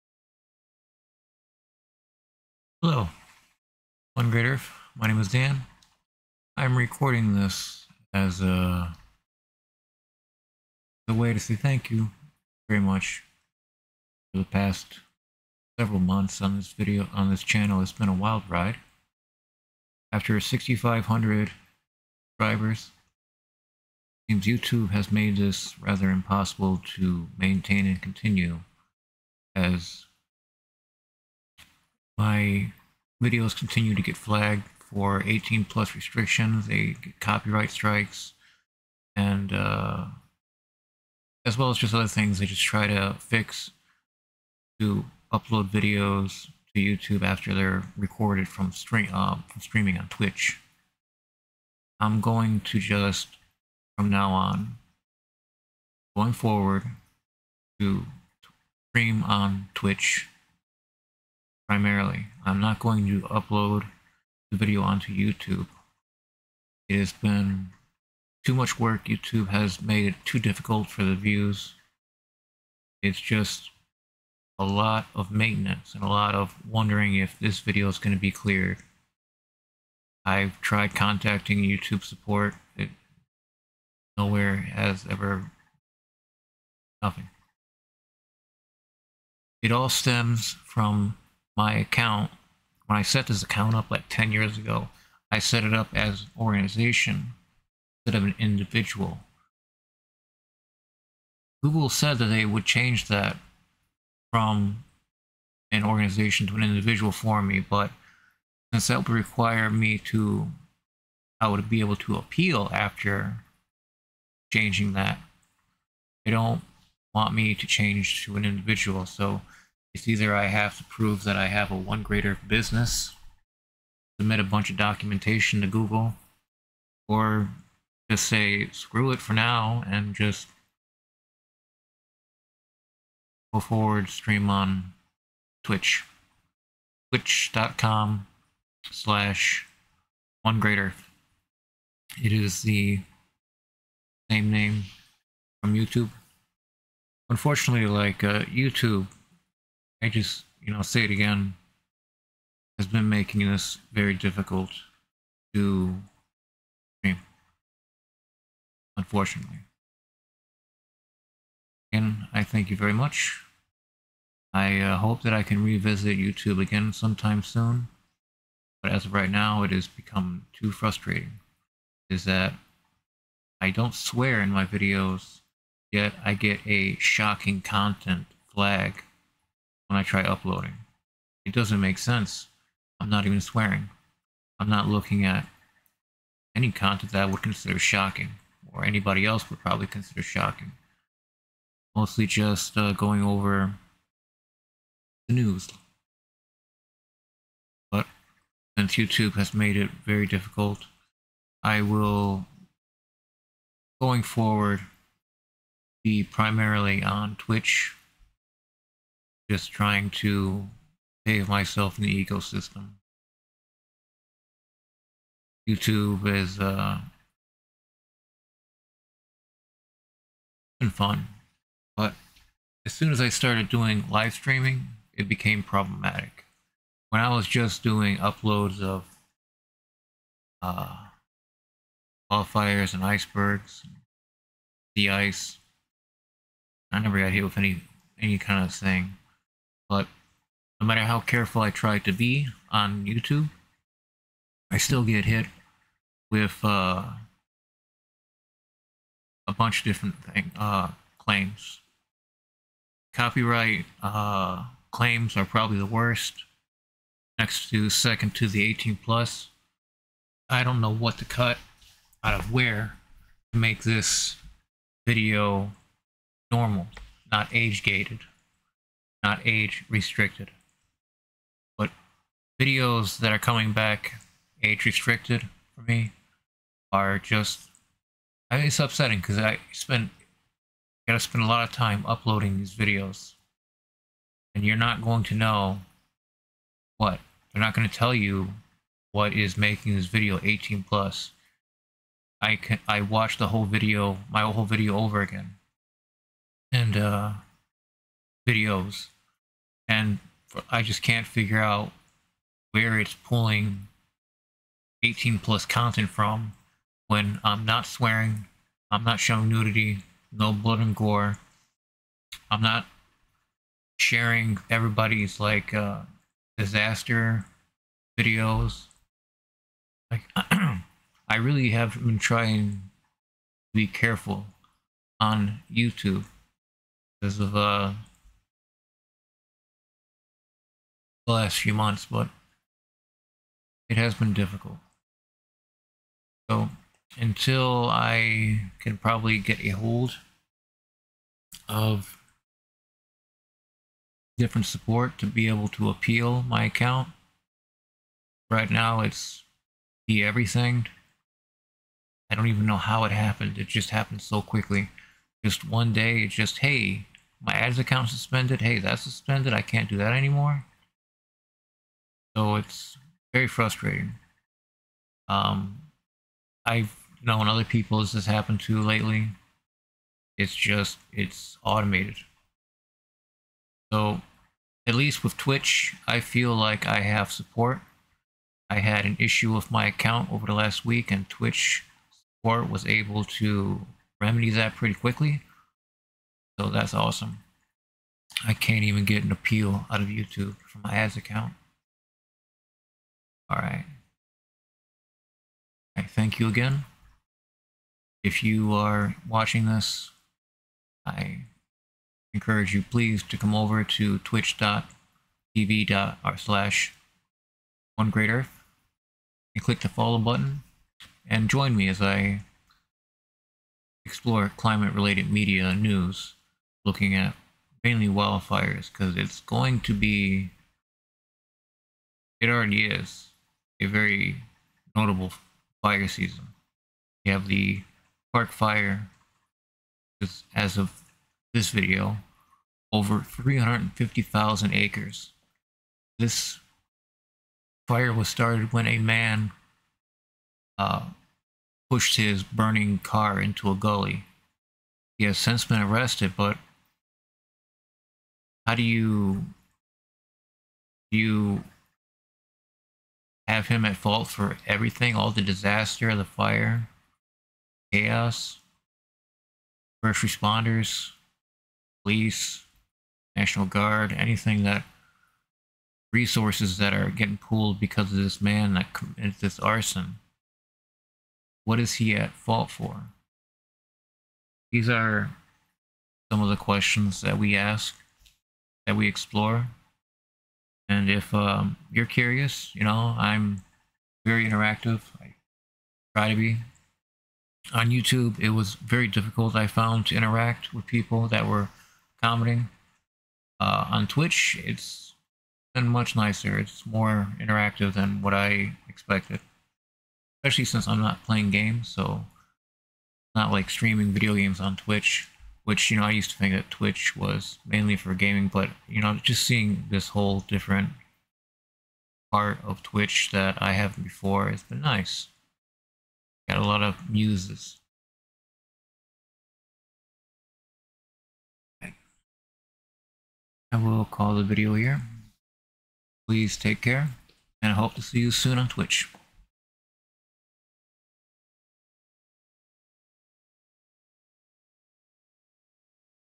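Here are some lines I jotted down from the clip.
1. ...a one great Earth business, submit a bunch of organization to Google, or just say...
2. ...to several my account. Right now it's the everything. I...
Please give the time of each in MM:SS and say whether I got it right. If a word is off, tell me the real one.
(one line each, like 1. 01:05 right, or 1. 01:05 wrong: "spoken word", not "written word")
1. 02:01 wrong: "documentation", not "organization"
2. 05:45 wrong: "appeal", not "several".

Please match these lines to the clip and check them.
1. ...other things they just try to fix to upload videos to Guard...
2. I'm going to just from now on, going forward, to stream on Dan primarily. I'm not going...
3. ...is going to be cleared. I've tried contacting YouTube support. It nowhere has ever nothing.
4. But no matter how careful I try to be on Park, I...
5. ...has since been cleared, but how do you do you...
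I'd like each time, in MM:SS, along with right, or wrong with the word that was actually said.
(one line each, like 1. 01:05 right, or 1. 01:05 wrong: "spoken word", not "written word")
1. 00:41 wrong: "YouTube", not "Guard"
2. 00:51 wrong: "Twitch", not "Dan"
3. 01:17 right
4. 03:59 wrong: "YouTube", not "Park"
5. 07:25 wrong: "arrested", not "cleared".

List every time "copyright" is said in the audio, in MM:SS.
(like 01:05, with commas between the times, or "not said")
00:37, 04:13.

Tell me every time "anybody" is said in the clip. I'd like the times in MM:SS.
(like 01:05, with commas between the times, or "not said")
03:08.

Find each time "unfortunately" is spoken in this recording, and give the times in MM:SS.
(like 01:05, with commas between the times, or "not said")
02:27, 02:38.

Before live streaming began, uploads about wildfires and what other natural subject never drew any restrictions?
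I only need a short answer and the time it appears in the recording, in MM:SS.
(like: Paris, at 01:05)
icebergs, at 03:53.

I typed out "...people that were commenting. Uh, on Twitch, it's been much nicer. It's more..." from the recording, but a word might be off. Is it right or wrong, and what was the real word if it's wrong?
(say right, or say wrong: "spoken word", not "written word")
right.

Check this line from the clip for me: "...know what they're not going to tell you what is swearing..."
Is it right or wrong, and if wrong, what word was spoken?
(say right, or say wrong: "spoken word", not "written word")
wrong: "making", not "swearing".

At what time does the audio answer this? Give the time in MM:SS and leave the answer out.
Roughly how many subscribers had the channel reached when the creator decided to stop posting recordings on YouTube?
00:20.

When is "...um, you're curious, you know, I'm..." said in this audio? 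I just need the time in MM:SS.
08:01.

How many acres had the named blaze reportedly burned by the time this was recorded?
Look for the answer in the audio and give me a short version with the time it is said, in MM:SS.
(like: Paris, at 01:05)
over 350,000 acres, at 07:12.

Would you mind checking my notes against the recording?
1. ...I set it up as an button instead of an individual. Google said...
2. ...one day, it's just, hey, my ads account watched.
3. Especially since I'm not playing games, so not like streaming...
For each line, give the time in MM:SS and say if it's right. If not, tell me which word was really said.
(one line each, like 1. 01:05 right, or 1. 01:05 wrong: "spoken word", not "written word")
1. 01:35 wrong: "organization", not "button"
2. 05:55 wrong: "suspended", not "watched"
3. 08:20 right.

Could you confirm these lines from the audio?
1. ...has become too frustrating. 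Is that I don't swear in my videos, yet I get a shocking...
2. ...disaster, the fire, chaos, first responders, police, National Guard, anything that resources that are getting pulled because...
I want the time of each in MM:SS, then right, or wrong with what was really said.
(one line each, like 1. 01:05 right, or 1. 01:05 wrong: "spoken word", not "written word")
1. 02:49 right
2. 07:35 right.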